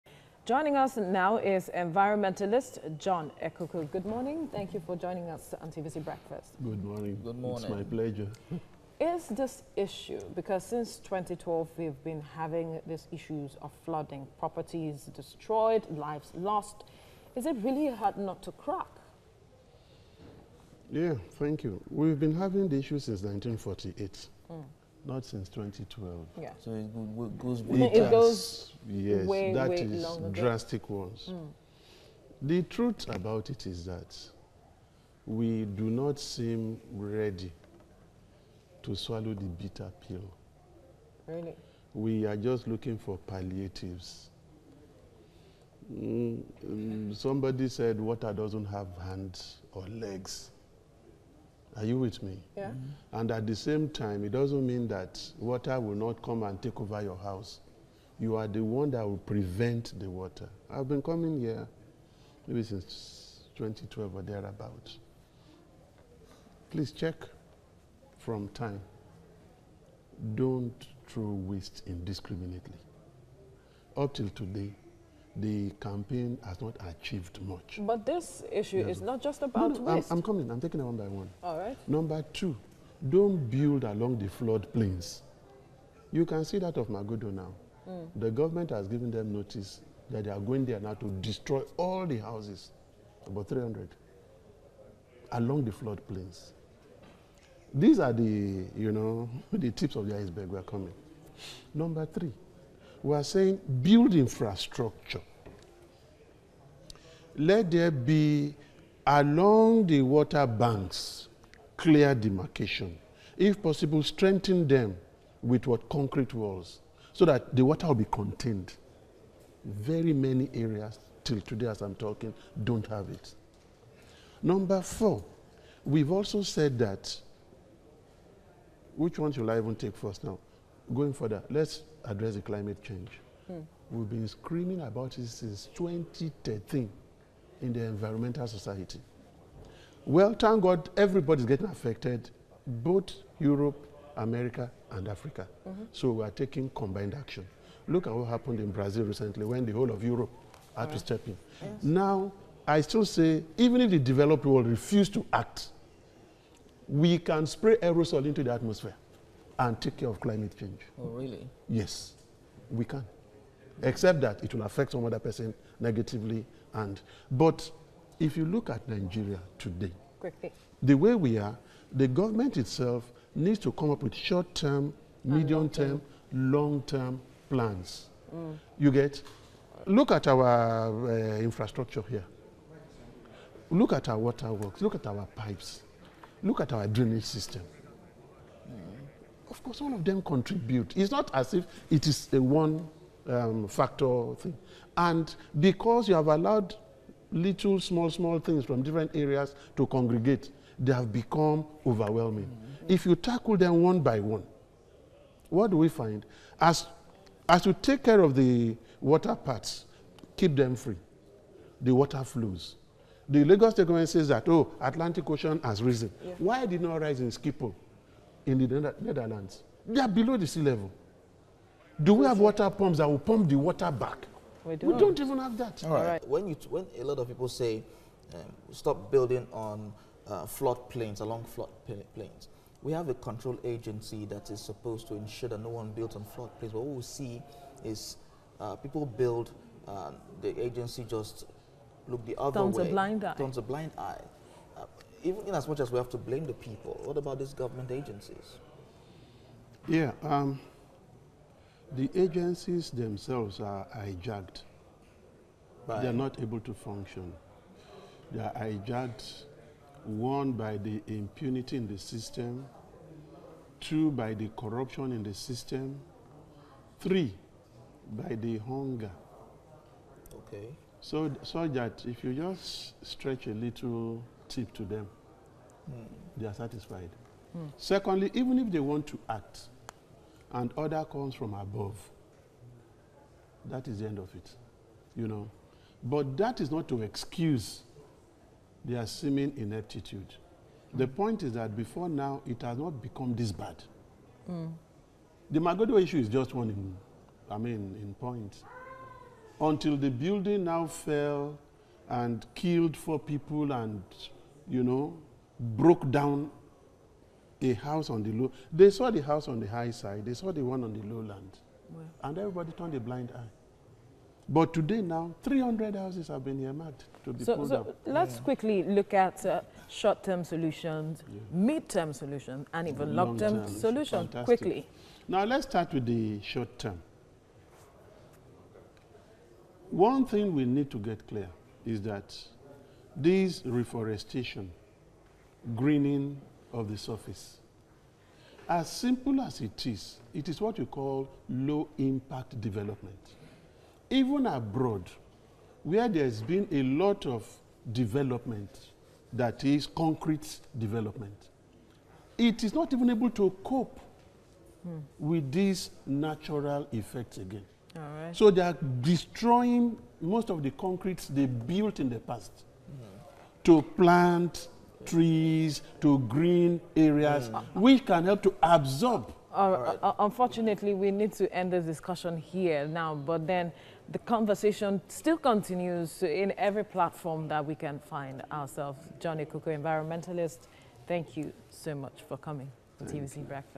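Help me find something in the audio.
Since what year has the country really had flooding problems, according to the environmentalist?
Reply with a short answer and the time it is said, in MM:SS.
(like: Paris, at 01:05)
1948, at 00:23.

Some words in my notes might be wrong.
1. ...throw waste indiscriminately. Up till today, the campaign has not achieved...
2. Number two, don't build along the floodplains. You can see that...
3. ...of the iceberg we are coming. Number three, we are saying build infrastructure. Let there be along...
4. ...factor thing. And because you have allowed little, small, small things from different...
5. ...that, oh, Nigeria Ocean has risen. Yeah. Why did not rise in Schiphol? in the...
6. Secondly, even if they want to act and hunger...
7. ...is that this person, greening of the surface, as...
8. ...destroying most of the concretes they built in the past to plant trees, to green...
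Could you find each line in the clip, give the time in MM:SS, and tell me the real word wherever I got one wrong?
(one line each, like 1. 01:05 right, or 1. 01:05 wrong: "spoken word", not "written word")
1. 01:11 right
2. 01:21 right
3. 01:39 right
4. 03:13 right
5. 03:34 wrong: "Atlantic", not "Nigeria"
6. 04:37 wrong: "order", not "hunger"
7. 05:31 wrong: "reforestation", not "person"
8. 05:59 right.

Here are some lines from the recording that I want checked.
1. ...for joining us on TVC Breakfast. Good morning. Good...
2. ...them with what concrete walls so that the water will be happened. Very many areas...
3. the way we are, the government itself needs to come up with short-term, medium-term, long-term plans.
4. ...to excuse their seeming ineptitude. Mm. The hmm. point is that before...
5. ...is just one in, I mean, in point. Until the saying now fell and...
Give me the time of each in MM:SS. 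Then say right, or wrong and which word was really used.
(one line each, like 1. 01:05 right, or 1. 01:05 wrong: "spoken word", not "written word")
1. 00:04 right
2. 01:54 wrong: "contained", not "happened"
3. 02:50 right
4. 04:46 right
5. 04:56 wrong: "building", not "saying".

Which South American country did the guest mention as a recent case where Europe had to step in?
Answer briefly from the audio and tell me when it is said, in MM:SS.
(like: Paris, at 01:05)
Brazil, at 02:28.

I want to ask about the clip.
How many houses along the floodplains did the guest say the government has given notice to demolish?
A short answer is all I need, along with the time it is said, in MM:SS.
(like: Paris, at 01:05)
300, at 01:33.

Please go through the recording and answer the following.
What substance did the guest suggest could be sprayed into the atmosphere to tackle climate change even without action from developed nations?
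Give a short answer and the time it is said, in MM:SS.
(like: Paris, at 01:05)
aerosol, at 02:37.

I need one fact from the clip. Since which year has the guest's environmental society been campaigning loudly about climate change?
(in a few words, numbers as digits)
2013.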